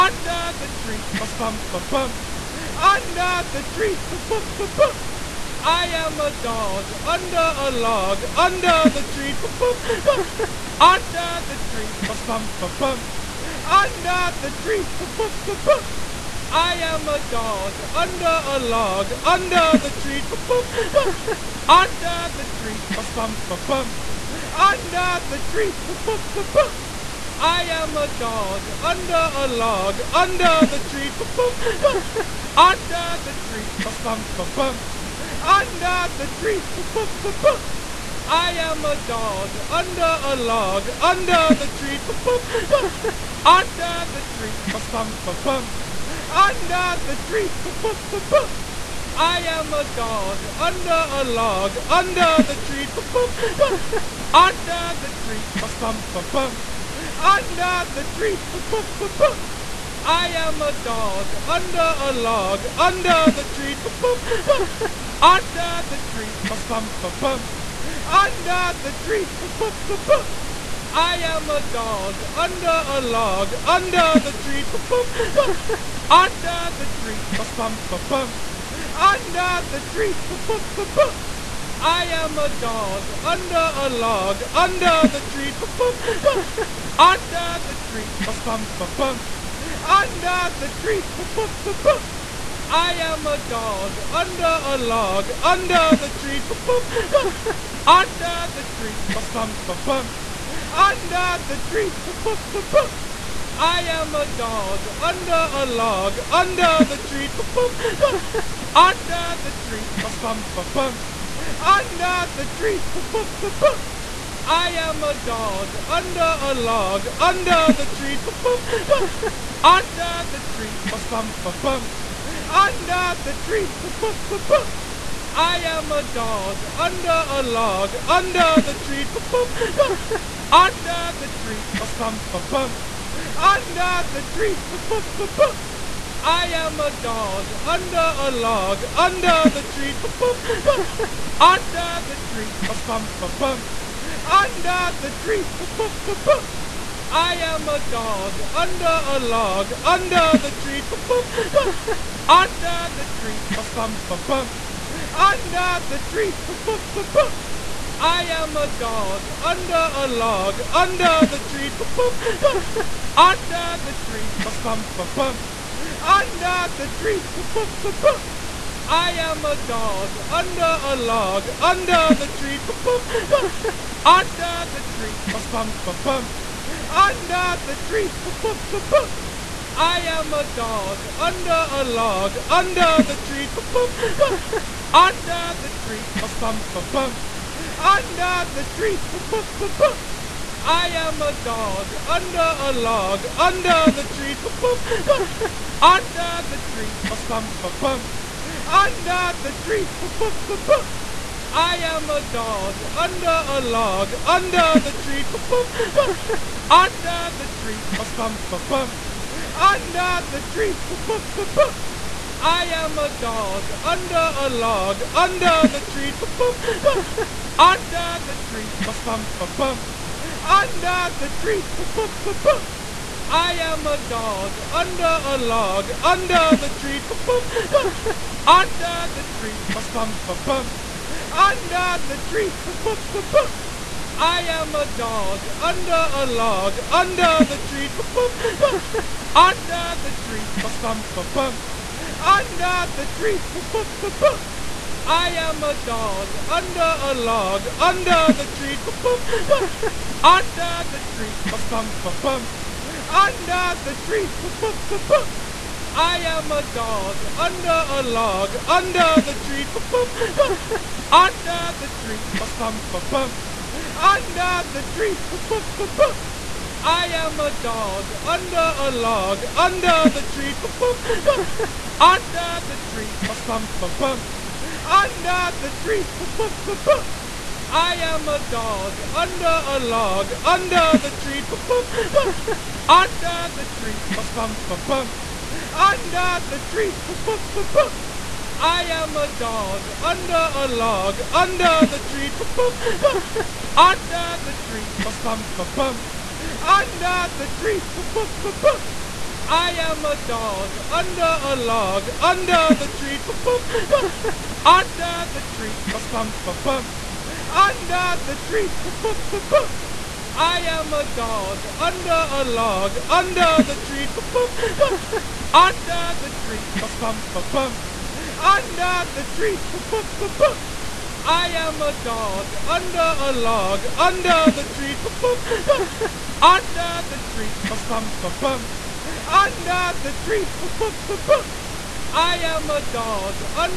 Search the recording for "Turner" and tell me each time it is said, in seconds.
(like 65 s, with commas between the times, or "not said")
not said.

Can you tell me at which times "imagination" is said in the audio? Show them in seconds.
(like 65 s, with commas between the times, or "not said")
not said.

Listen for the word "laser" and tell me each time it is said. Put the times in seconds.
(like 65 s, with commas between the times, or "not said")
not said.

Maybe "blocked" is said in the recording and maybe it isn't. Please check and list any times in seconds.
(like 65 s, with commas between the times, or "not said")
not said.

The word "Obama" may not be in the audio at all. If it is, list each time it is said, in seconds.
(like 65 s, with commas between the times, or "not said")
not said.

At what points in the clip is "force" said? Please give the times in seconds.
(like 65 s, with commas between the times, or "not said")
not said.